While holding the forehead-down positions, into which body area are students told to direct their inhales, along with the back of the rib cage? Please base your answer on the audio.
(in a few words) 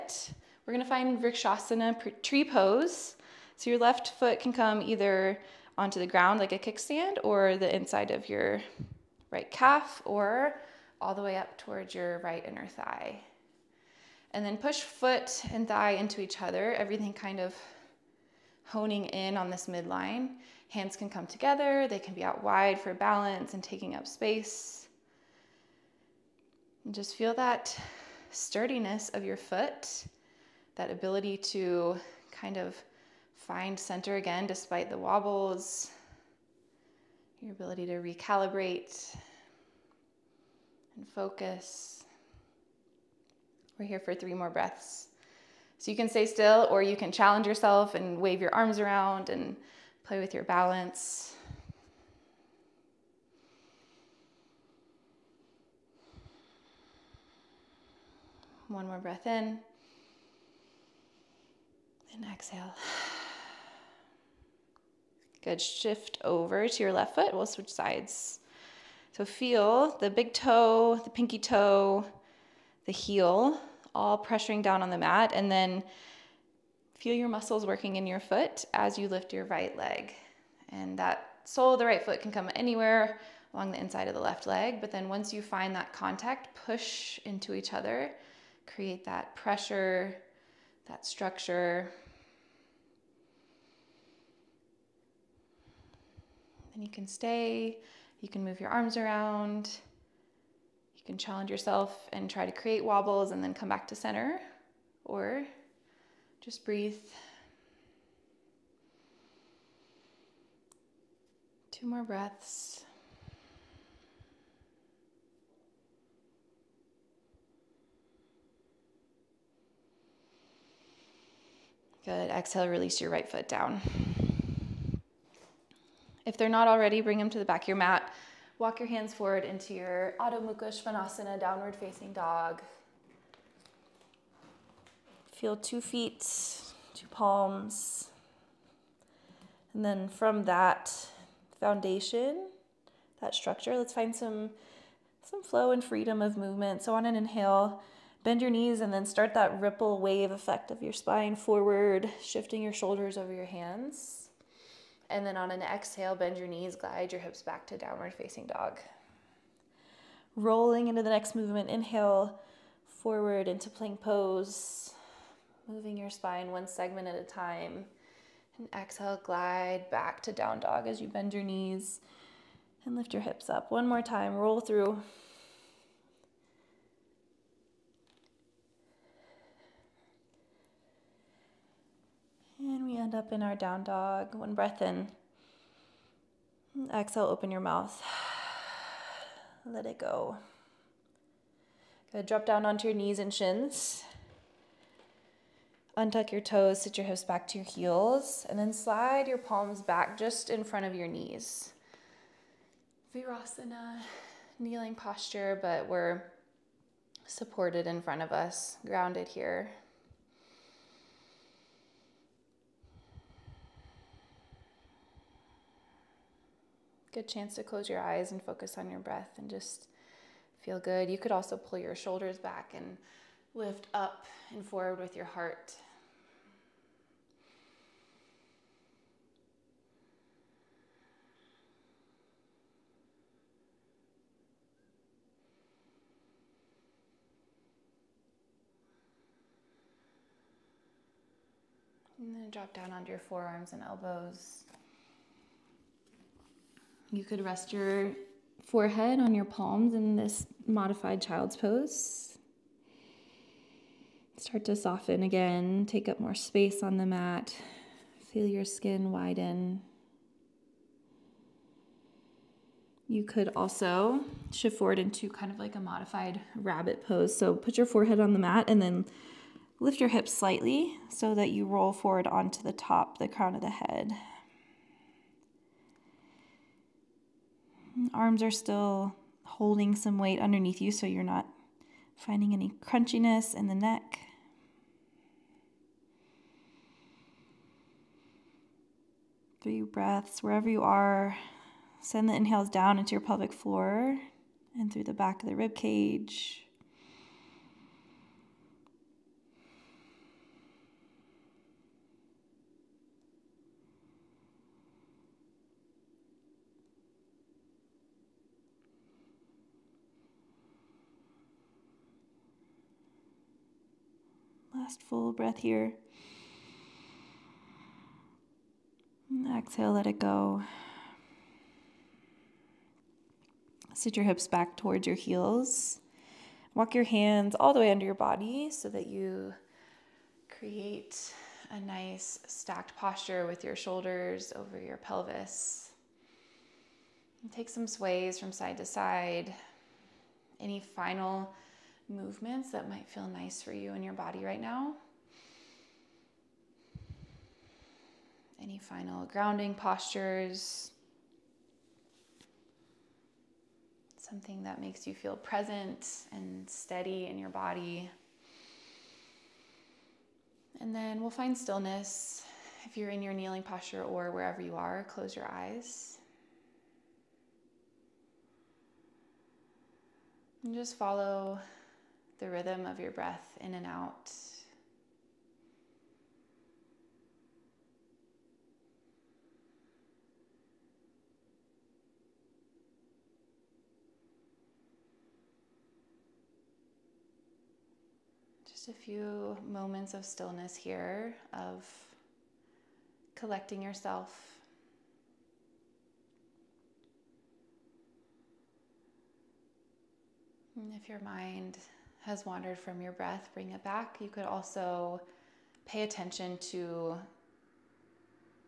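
pelvic floor.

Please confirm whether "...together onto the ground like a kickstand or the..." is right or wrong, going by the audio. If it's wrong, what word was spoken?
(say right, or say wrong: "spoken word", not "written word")
wrong: "either", not "together".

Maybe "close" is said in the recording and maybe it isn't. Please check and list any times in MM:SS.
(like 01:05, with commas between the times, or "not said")
03:37, 06:05.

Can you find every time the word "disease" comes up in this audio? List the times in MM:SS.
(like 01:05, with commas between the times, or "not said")
not said.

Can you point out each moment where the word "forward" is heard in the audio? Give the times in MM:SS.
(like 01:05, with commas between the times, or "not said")
02:09, 02:31, 02:42, 03:44, 04:24, 04:31.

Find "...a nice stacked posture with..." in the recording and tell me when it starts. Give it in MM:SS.
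05:31.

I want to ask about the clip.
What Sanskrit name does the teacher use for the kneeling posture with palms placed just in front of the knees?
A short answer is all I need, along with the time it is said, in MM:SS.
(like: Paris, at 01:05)
Virasana, at 03:23.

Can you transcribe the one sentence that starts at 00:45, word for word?
So you can stay still or you can challenge yourself and wave your arms around and play with your balance.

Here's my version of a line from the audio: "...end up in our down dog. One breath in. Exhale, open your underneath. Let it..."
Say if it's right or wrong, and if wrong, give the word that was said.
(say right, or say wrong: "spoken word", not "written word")
wrong: "mouth", not "underneath".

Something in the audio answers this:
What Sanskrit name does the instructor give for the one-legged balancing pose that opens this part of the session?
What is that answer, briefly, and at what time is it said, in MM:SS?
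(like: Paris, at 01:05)
Vrikshasana, at 00:01.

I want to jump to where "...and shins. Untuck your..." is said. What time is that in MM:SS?
03:13.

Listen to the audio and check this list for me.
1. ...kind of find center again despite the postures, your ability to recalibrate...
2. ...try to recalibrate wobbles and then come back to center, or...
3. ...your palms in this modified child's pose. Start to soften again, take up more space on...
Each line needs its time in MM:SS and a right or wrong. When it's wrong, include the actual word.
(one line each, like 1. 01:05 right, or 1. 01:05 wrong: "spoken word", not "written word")
1. 00:32 wrong: "wobbles", not "postures"
2. 01:42 wrong: "create", not "recalibrate"
3. 04:09 right.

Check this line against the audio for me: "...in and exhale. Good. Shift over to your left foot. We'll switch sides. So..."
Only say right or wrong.
right.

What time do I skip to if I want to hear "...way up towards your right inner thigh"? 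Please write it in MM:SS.
00:11.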